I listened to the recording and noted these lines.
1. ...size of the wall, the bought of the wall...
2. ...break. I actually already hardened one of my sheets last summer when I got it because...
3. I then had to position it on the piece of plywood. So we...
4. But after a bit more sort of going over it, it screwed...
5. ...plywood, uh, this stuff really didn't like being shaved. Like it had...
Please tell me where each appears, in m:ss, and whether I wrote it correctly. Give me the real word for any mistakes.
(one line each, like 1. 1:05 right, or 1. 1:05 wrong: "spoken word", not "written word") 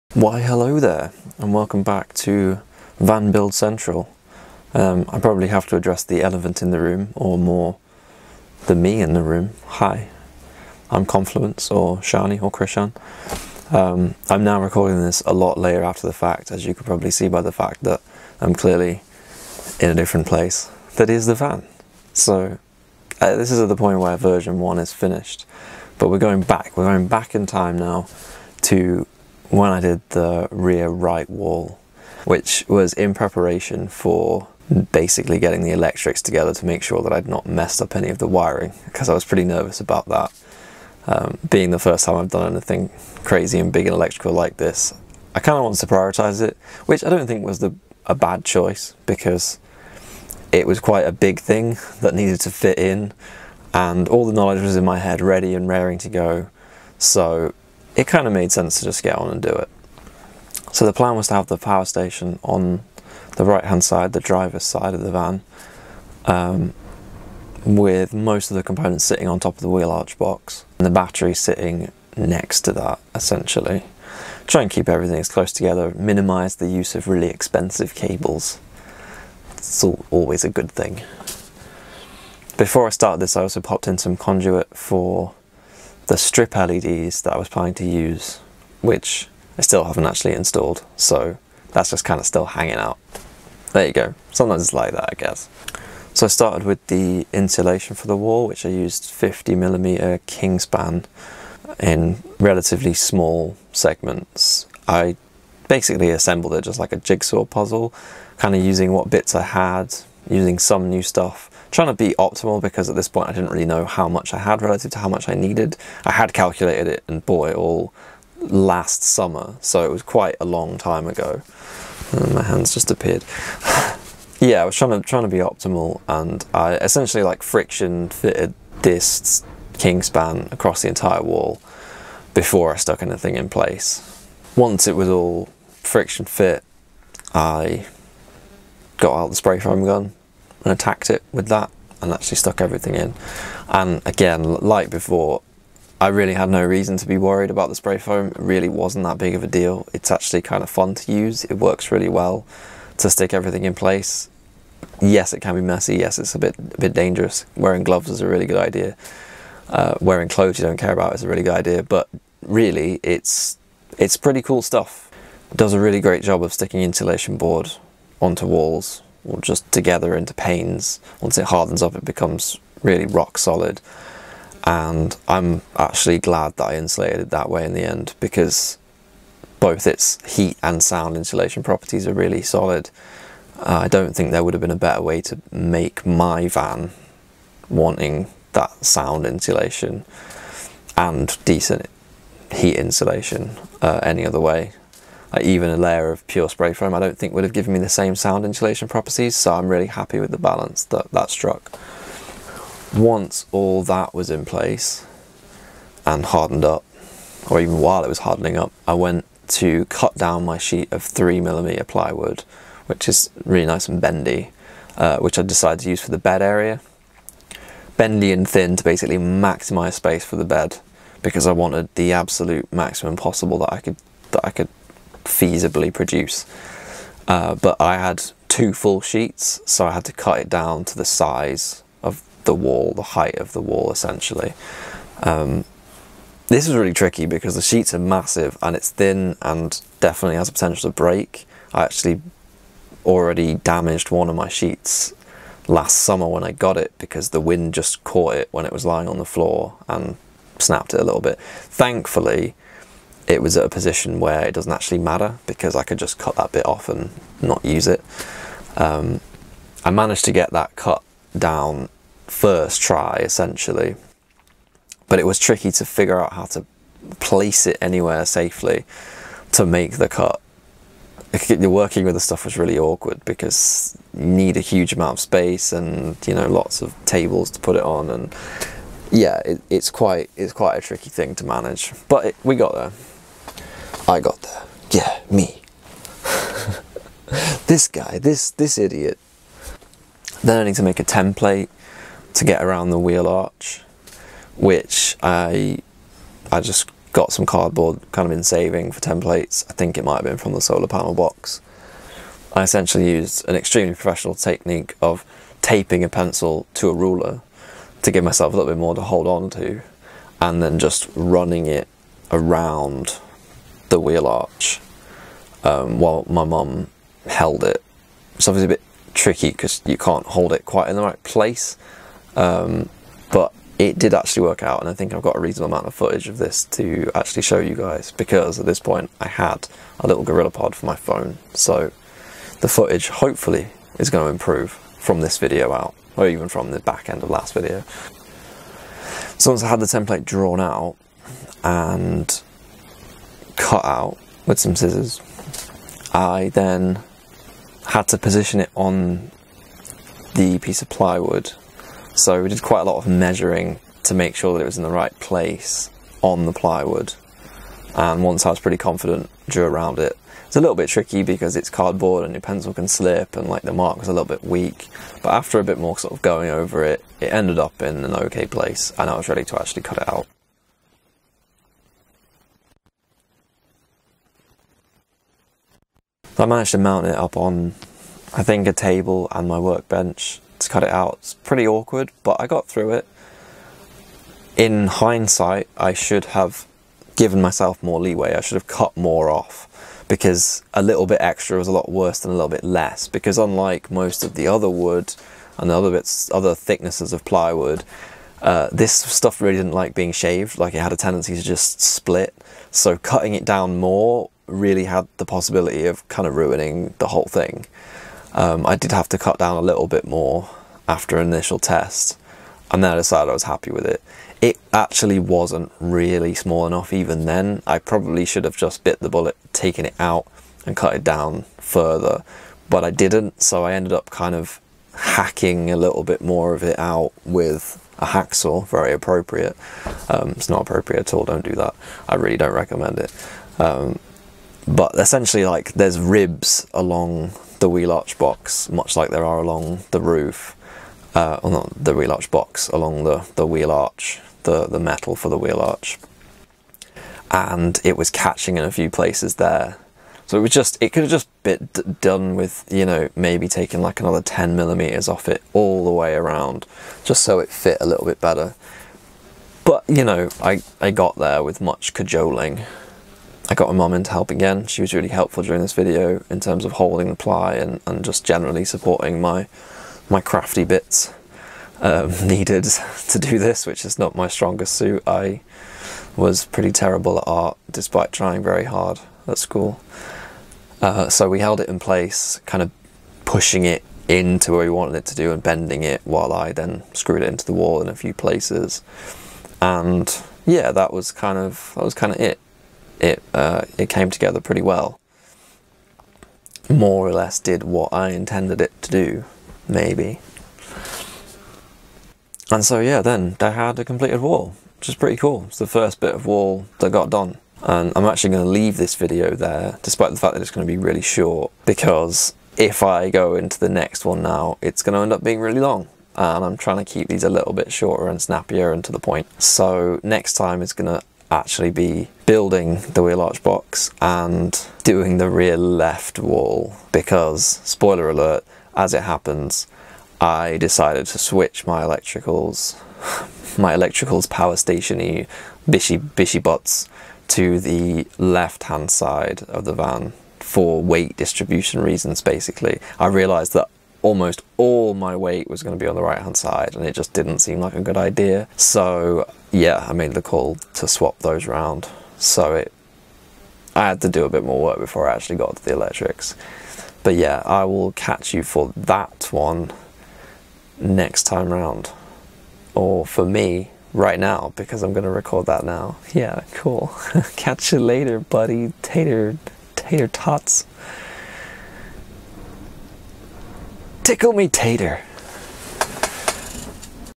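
1. 3:51 wrong: "height", not "bought"
2. 4:00 wrong: "damaged", not "hardened"
3. 5:46 right
4. 6:05 wrong: "ended", not "screwed"
5. 6:37 right.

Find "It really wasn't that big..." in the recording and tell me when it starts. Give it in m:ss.
2:28.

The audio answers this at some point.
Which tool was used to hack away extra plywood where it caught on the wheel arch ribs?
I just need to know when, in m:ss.
7:08.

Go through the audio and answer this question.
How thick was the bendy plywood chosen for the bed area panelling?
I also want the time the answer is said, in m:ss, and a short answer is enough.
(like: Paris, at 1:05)
3 millimetre, at 3:31.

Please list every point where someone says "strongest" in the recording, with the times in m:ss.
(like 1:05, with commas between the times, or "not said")
7:54.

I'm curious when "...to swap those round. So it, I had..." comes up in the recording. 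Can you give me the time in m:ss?
9:10.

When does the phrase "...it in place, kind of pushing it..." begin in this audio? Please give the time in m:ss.
8:01.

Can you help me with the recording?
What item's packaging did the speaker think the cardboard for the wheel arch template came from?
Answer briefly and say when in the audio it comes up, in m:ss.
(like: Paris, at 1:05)
solar panel box, at 5:00.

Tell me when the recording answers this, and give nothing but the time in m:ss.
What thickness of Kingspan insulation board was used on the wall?
1:39.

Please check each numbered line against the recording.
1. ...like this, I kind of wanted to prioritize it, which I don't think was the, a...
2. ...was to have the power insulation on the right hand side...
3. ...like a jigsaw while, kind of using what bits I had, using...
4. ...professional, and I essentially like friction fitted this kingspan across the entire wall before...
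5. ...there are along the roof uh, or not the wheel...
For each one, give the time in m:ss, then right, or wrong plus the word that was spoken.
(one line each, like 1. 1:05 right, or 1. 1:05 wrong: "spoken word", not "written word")
1. 0:44 right
2. 1:01 wrong: "station", not "insulation"
3. 1:46 wrong: "puzzle", not "while"
4. 2:05 wrong: "optimal", not "professional"
5. 7:19 right.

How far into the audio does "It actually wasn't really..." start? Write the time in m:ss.
6:54.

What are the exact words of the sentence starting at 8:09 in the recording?
And yeah, that was kind of that was kind of it it uh, it came together pretty well.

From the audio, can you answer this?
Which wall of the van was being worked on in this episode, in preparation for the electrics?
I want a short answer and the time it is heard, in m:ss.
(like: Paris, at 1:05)
rear right wall, at 0:30.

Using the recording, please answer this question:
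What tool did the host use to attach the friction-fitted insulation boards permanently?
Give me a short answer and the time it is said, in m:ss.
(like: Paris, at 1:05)
spray foam gun, at 2:19.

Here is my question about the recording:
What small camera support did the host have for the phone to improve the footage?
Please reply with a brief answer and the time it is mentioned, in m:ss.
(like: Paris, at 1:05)
Gorilla Pod, at 5:30.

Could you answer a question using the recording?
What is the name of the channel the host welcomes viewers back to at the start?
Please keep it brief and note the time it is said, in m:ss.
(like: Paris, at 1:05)
Van Build Central, at 0:02.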